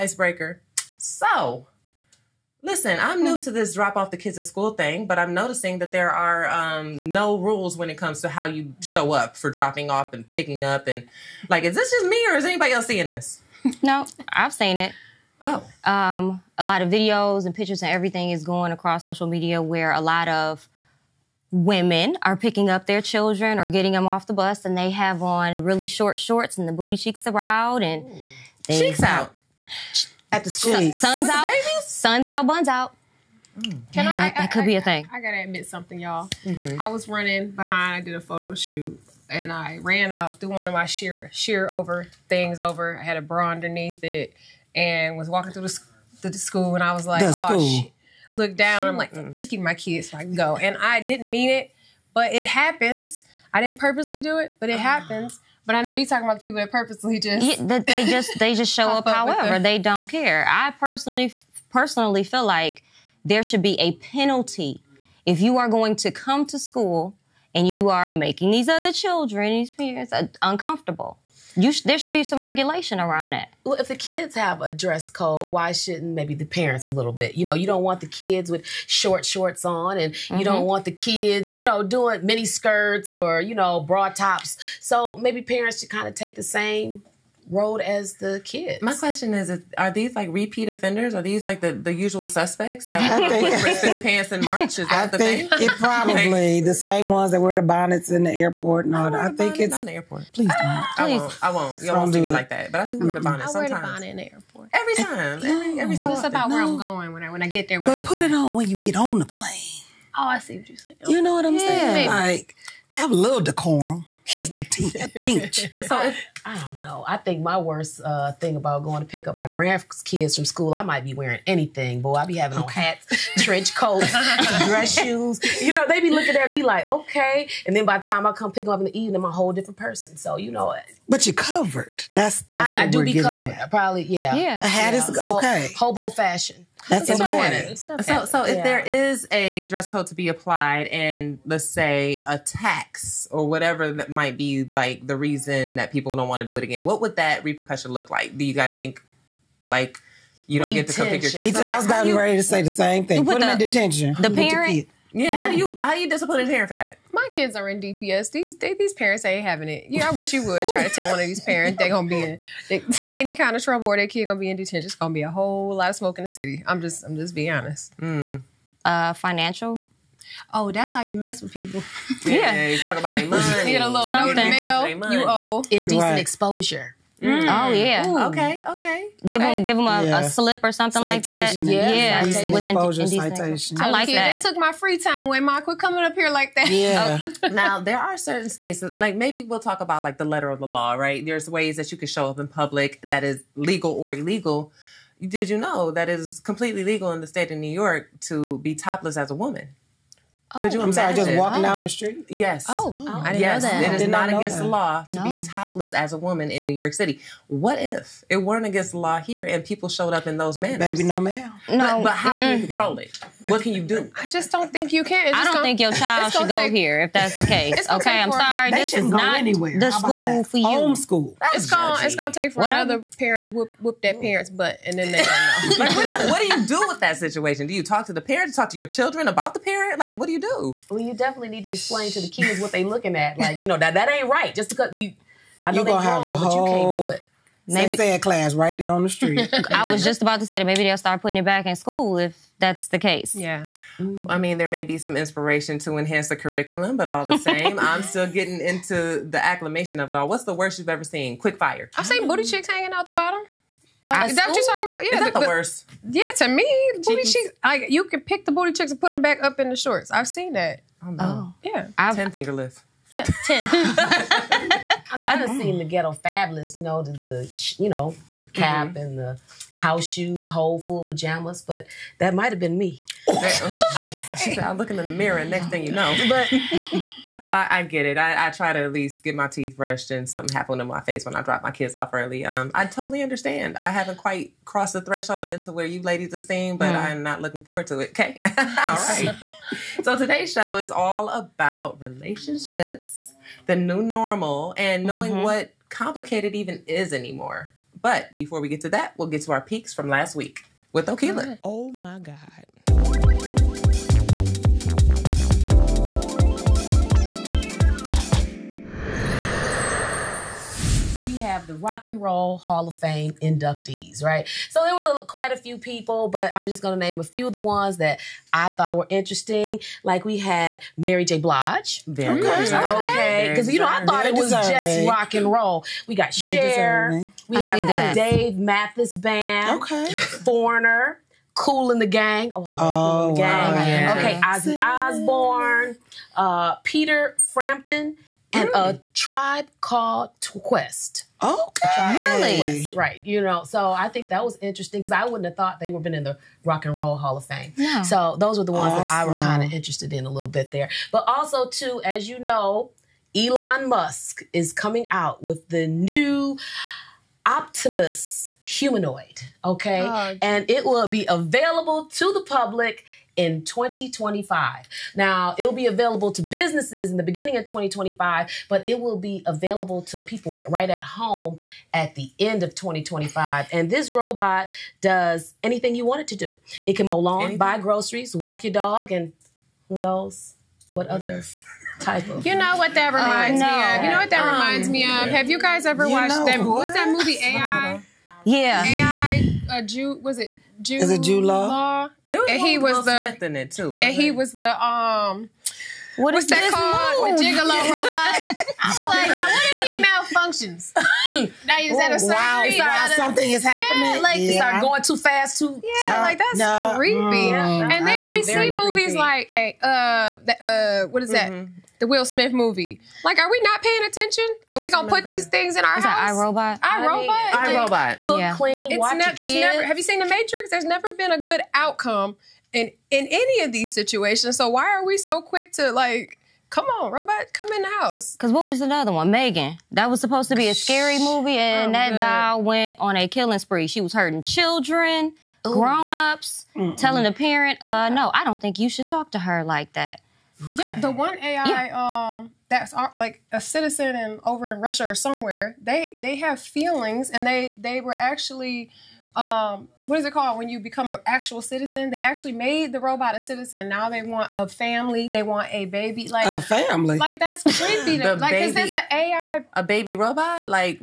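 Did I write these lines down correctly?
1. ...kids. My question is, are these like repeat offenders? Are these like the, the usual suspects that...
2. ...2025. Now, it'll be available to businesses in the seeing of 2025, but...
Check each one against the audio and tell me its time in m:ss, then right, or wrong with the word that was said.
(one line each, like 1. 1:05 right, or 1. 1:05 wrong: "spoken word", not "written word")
1. 1:28 right
2. 6:03 wrong: "beginning", not "seeing".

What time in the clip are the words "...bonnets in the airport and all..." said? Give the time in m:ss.
1:37.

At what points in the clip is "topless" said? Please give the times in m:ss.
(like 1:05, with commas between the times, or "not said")
3:18, 3:25.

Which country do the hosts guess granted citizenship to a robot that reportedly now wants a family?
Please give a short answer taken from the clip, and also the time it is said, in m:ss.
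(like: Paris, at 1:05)
Russia, at 7:24.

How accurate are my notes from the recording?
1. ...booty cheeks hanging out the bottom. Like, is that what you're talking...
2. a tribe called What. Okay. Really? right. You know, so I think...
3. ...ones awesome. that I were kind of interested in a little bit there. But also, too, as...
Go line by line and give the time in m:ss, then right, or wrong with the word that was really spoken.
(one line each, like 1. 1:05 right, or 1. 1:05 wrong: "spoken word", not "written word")
1. 4:12 wrong: "chicks", not "cheeks"
2. 5:38 wrong: "Quest", not "What"
3. 5:48 right.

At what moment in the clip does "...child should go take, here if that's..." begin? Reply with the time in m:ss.
3:35.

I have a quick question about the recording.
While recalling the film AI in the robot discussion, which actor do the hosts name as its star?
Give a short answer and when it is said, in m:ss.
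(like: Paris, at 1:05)
Jude Law, at 6:31.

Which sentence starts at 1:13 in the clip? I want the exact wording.
Well, if the kids have a dress code, why shouldn't maybe the parents a little bit?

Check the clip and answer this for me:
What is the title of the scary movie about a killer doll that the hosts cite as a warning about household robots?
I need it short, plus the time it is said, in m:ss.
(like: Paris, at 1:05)
Megan, at 7:09.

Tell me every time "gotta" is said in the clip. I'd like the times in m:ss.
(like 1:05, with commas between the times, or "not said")
0:35.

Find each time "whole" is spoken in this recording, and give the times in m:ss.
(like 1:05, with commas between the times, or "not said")
2:09, 2:45, 4:30.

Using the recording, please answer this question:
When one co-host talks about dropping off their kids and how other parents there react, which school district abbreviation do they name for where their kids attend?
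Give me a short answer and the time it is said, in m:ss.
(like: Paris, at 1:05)
DPS, at 2:37.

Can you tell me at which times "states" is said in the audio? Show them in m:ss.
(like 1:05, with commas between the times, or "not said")
3:08, 3:17.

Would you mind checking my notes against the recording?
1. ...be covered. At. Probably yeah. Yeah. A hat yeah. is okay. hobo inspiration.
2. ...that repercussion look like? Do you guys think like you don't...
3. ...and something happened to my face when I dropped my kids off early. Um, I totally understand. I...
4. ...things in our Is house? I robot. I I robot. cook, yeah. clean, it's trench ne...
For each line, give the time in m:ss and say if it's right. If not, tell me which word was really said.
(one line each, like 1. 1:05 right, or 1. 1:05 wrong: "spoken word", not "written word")
1. 2:13 wrong: "fashion", not "inspiration"
2. 2:27 right
3. 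4:40 right
4. 6:55 wrong: "watch", not "trench".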